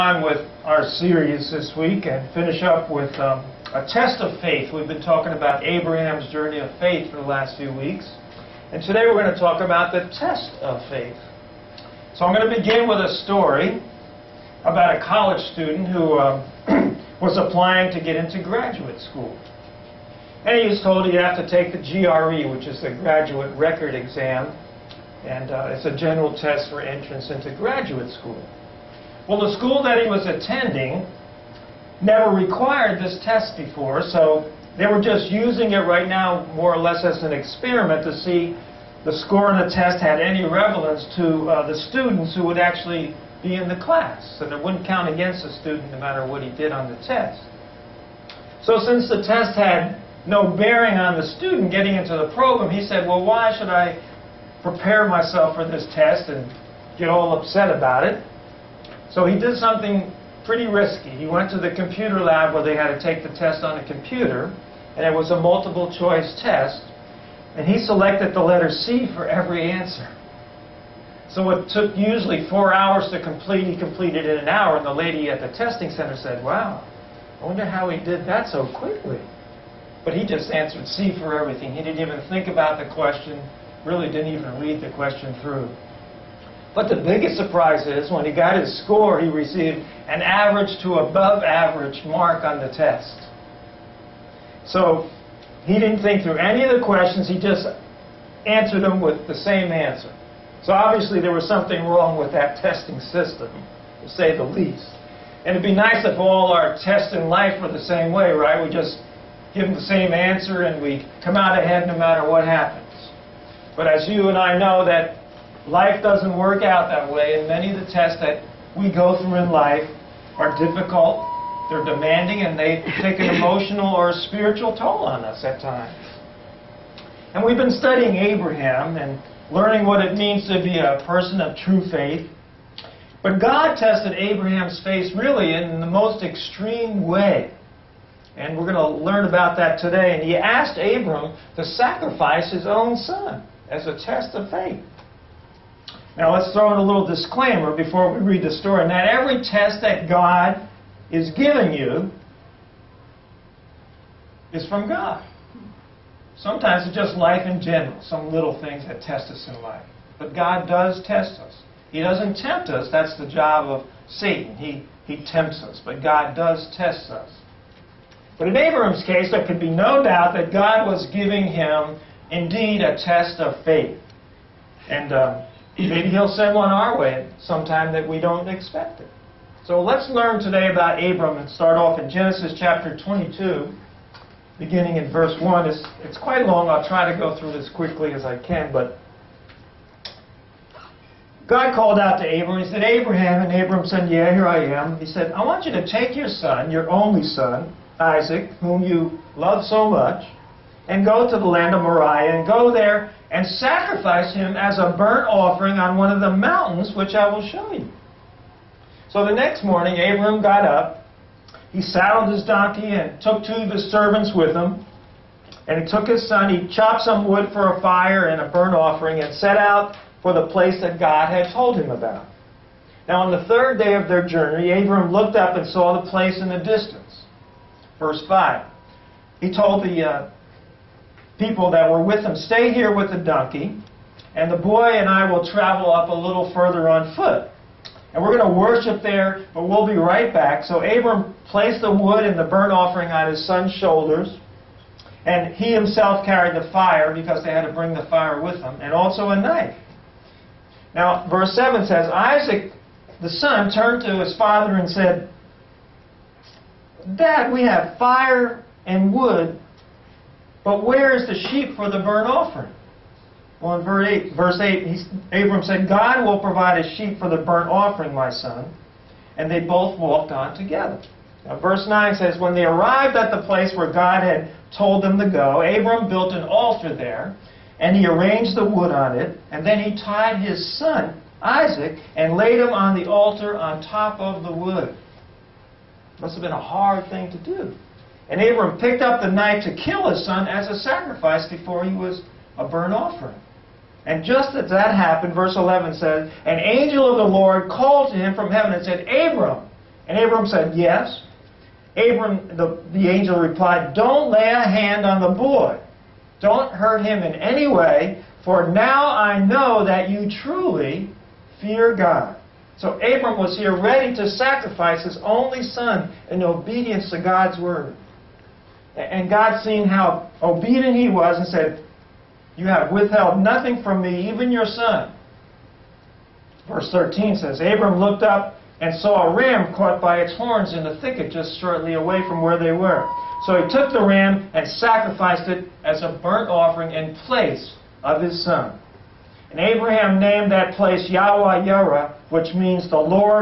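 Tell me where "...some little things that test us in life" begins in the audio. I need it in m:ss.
2:38.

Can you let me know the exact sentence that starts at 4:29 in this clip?
And they both walked on together.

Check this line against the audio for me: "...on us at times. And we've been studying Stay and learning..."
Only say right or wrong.
wrong.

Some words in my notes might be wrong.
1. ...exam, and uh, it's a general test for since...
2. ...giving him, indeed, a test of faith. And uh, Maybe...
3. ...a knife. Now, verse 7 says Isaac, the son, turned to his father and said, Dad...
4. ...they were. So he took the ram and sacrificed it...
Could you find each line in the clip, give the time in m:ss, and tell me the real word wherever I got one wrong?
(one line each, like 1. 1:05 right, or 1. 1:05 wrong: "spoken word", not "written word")
1. 0:23 wrong: "entrance", not "since"
2. 2:51 right
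3. 4:09 right
4. 5:32 right.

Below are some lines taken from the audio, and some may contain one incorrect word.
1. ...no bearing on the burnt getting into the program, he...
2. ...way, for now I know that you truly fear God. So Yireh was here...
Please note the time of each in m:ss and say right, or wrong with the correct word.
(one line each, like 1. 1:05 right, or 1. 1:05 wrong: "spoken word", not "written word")
1. 0:50 wrong: "student", not "burnt"
2. 5:07 wrong: "Abram", not "Yireh".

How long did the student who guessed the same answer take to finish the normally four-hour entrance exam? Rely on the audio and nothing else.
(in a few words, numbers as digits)
an hour.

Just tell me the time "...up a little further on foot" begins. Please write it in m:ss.
3:55.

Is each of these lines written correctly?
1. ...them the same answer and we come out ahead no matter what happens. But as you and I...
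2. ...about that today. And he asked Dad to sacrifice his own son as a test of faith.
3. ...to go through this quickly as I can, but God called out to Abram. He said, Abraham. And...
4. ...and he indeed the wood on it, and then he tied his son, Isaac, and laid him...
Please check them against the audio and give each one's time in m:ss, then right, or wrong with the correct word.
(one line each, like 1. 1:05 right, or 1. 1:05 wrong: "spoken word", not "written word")
1. 1:49 right
2. 2:19 wrong: "Abram", not "Dad"
3. 3:07 right
4. 4:37 wrong: "arranged", not "indeed".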